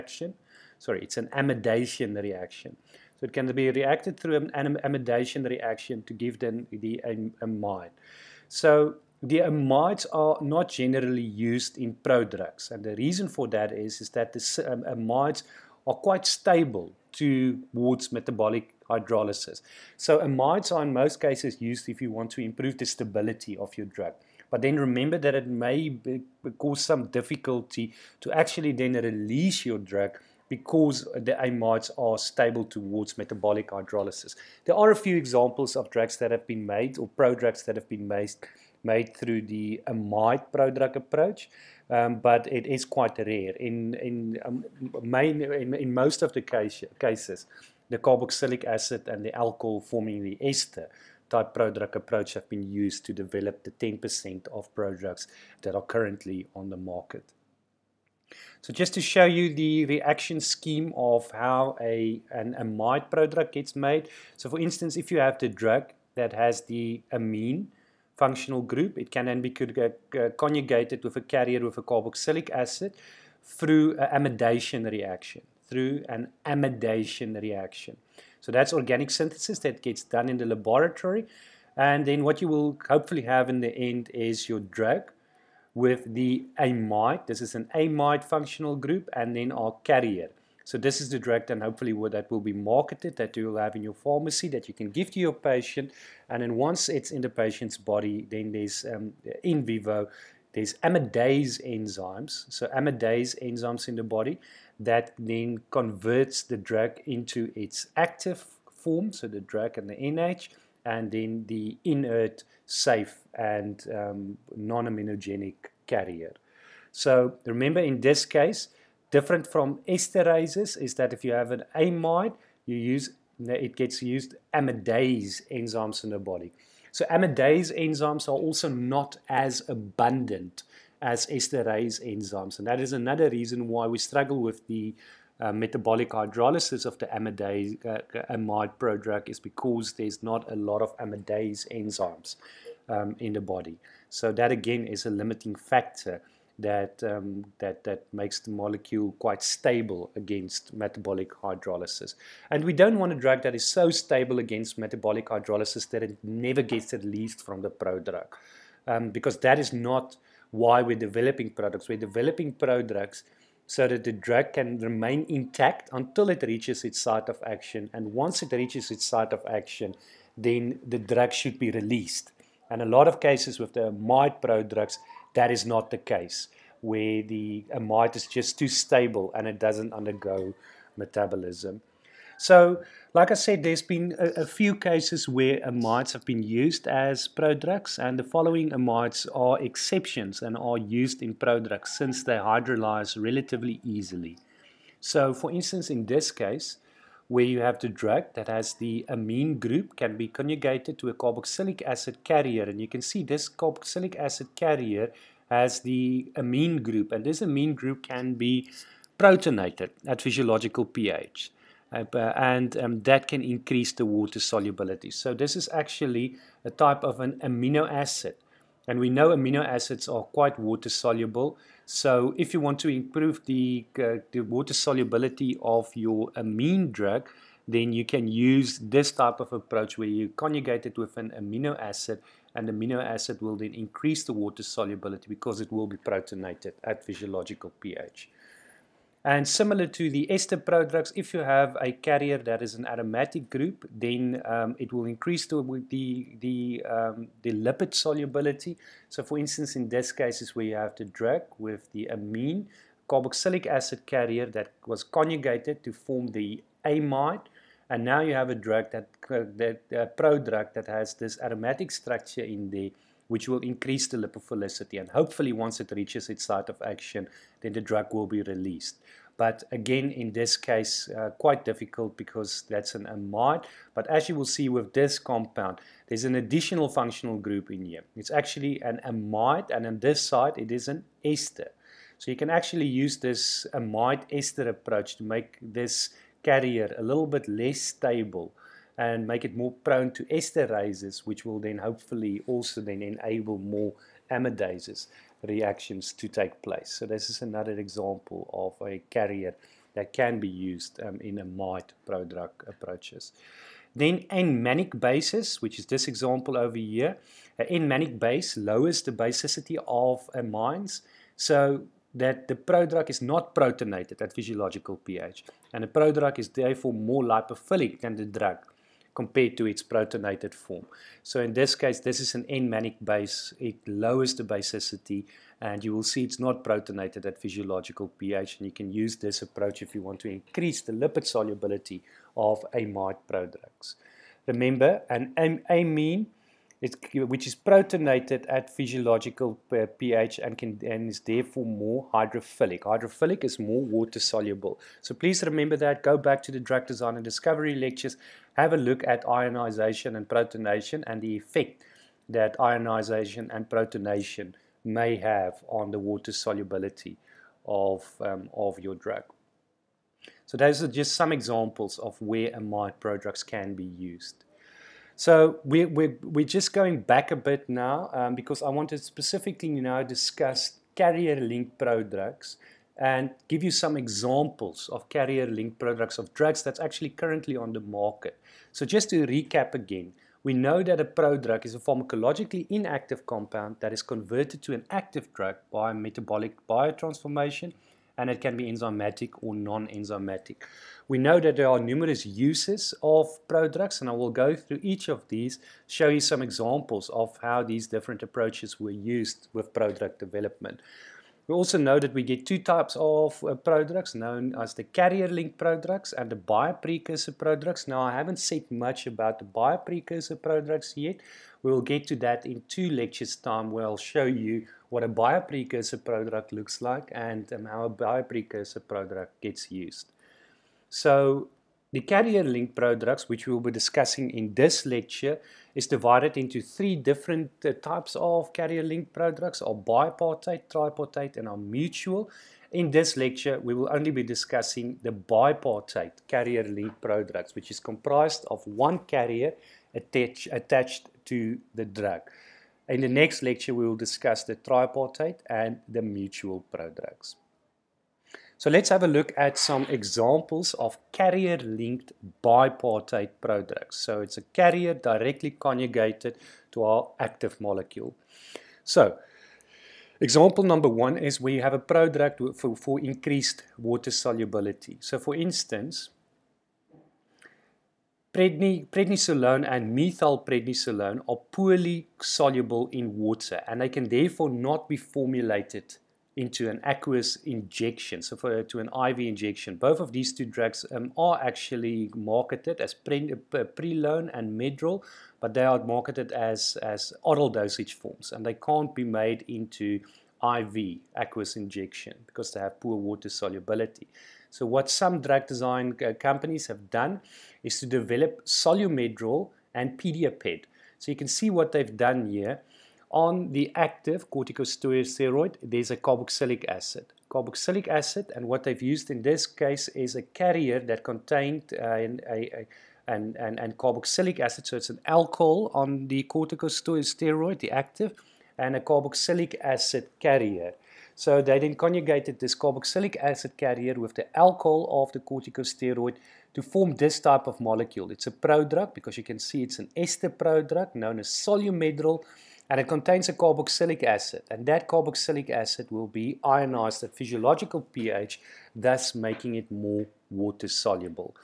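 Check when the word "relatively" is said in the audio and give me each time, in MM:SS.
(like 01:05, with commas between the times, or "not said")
03:13.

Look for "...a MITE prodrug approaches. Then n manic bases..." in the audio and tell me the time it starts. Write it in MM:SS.
05:01.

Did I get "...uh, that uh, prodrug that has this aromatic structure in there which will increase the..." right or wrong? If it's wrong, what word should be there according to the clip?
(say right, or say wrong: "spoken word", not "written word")
right.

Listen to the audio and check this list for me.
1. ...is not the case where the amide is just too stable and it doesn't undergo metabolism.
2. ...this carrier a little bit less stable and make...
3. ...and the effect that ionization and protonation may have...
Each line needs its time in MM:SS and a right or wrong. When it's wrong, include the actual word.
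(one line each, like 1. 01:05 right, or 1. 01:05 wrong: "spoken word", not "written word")
1. 02:55 right
2. 04:45 right
3. 05:51 right.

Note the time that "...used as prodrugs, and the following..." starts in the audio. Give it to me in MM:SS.
03:06.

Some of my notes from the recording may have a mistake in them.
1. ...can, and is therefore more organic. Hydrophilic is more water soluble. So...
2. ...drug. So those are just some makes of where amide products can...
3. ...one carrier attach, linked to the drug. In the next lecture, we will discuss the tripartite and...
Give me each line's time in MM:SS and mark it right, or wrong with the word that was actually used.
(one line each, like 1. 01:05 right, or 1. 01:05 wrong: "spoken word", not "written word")
1. 05:40 wrong: "hydrophilic", not "organic"
2. 05:58 wrong: "examples", not "makes"
3. 07:18 wrong: "attached", not "linked".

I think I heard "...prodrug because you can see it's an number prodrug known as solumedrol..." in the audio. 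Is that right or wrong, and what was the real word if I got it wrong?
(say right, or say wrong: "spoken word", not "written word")
wrong: "ester", not "number".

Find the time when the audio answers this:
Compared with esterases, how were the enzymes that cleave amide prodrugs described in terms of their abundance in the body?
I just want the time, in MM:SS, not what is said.
02:08.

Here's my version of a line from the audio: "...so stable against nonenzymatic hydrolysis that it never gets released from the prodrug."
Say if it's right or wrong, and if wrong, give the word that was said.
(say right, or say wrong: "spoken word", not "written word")
wrong: "metabolic", not "nonenzymatic".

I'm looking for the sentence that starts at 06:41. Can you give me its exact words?
We also know that we get two types of uh, prodrugs known as the carrier link prodrugs and the bioprecursor prodrugs.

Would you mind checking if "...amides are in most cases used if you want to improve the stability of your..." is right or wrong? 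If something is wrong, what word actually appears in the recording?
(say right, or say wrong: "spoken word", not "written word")
right.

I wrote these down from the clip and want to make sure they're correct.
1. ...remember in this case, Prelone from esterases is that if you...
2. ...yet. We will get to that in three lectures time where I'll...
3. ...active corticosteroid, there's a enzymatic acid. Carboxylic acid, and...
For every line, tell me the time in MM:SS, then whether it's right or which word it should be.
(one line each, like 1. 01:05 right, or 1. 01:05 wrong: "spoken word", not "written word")
1. 01:57 wrong: "Different", not "Prelone"
2. 06:50 wrong: "two", not "three"
3. 08:23 wrong: "carboxylic", not "enzymatic".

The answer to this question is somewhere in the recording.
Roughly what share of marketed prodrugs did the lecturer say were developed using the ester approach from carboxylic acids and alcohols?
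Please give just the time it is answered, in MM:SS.
00:53.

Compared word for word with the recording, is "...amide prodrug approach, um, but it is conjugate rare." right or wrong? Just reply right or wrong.
wrong.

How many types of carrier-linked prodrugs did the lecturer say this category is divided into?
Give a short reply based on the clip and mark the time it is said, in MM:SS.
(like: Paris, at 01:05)
3, at 07:06.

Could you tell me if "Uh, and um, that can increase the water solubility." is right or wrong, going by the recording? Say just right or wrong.
right.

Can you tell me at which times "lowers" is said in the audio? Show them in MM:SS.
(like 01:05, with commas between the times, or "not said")
05:08, 05:23.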